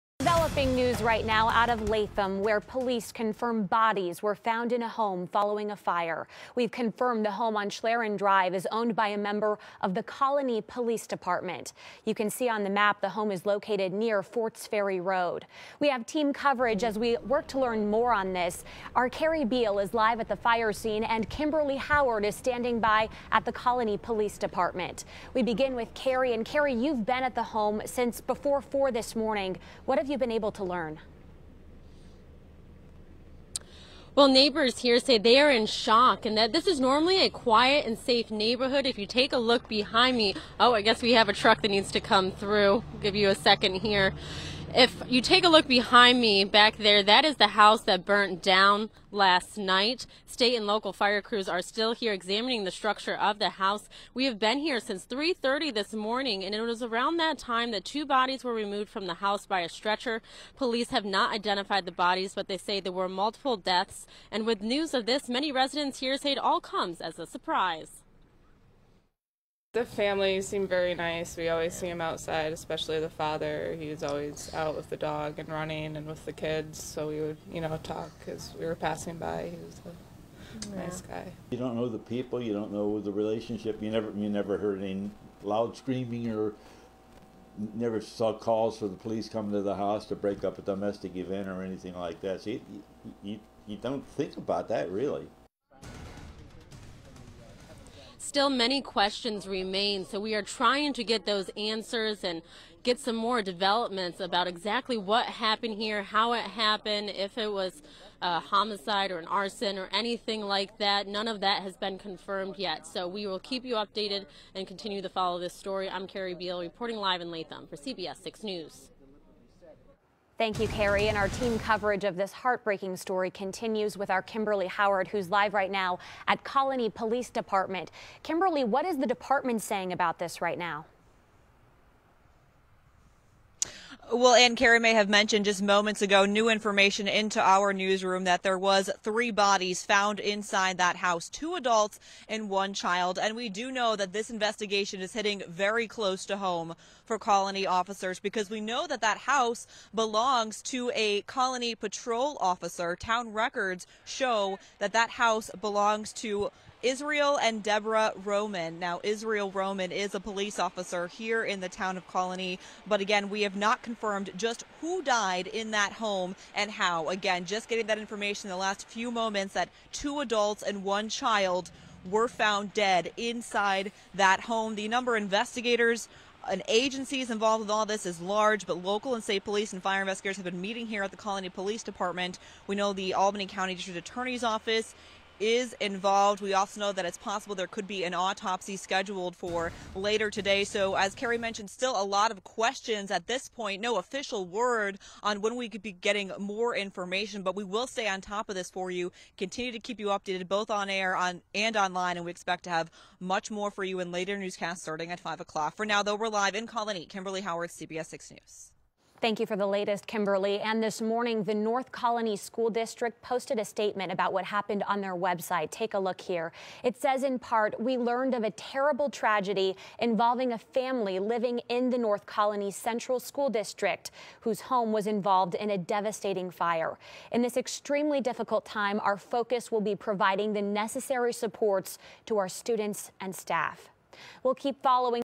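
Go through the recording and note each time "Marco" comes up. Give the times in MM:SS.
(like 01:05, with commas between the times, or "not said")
not said.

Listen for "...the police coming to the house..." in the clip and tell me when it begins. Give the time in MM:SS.
01:28.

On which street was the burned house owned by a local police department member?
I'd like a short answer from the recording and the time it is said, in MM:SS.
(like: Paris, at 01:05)
Schlerin Drive, at 00:07.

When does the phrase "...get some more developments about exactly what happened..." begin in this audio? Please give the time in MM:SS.
01:42.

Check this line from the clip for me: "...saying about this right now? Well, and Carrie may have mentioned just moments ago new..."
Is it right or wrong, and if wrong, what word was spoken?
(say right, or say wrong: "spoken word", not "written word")
right.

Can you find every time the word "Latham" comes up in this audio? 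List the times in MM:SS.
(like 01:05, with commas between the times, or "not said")
00:01, 01:57.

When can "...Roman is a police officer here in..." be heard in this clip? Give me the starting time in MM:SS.
02:39.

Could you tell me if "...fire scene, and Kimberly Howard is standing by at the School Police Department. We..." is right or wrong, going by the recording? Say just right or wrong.
wrong.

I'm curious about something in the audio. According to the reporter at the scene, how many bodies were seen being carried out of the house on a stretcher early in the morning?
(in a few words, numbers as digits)
2.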